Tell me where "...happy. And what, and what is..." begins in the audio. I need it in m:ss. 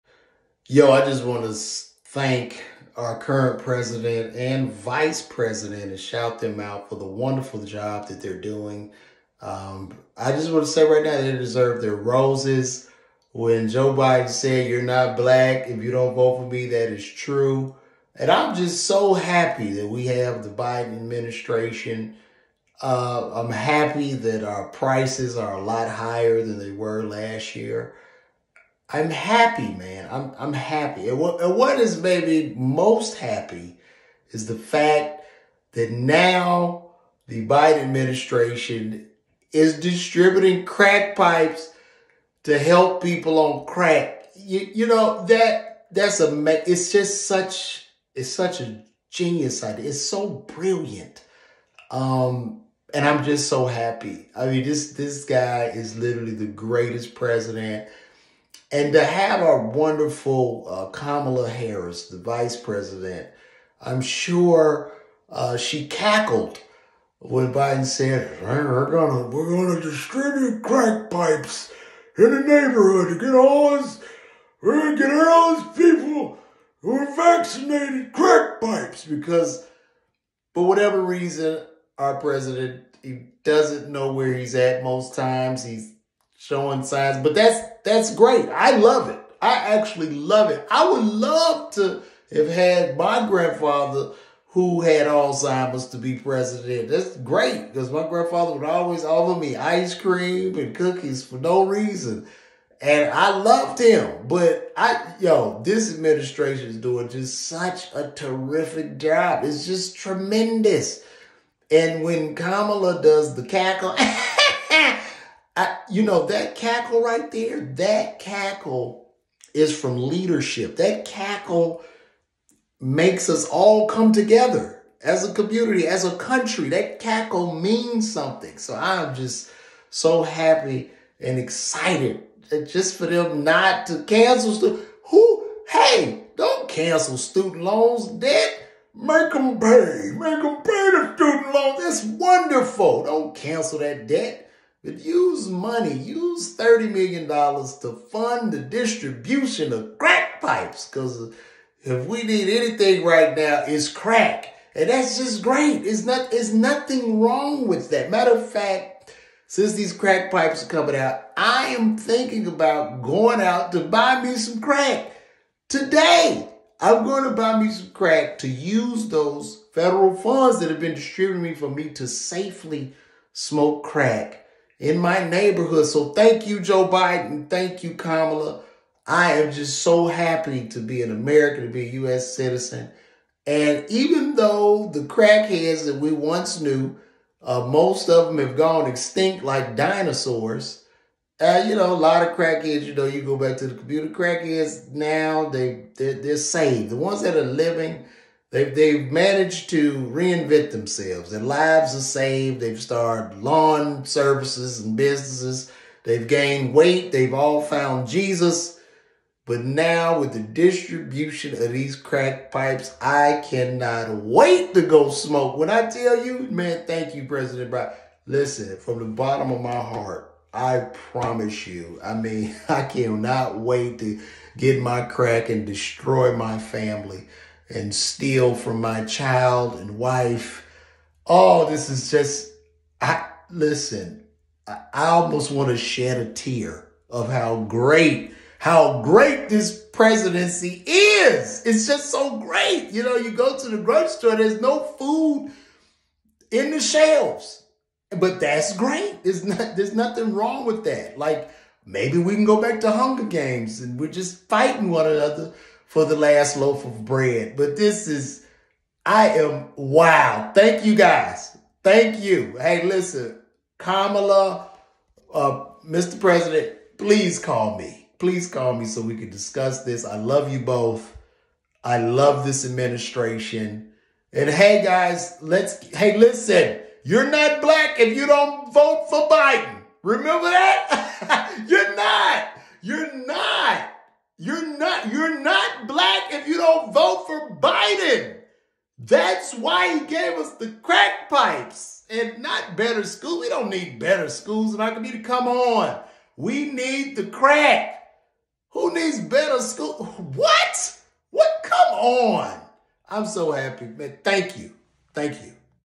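0:30.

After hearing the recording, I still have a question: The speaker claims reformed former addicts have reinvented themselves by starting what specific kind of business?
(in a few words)
lawn services.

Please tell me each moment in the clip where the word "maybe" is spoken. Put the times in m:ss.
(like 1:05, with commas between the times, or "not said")
0:32, 4:11.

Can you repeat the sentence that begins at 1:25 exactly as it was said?
He's showing signs, but that's that's great.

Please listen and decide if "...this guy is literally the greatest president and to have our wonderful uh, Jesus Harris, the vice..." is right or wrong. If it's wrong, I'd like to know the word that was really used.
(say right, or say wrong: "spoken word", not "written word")
wrong: "Kamala", not "Jesus".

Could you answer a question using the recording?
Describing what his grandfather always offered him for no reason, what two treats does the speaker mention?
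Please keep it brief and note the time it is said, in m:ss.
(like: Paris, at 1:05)
ice cream and cookies, at 1:39.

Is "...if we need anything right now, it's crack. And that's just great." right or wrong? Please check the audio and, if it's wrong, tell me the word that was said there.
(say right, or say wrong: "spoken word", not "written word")
right.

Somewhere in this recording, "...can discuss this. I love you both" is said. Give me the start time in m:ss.
4:29.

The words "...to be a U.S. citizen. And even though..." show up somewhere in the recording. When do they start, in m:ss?
3:01.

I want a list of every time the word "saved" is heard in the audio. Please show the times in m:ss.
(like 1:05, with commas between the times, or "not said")
3:16, 3:22.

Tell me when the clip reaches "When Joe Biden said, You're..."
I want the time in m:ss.
0:13.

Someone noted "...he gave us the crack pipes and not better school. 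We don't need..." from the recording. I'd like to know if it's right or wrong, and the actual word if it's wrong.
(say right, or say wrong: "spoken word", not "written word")
right.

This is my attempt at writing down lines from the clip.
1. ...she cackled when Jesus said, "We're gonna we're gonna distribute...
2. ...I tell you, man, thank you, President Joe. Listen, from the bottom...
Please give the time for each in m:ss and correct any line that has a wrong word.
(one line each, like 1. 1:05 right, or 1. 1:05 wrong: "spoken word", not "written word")
1. 1:05 wrong: "Biden", not "Jesus"
2. 3:35 wrong: "Biden", not "Joe".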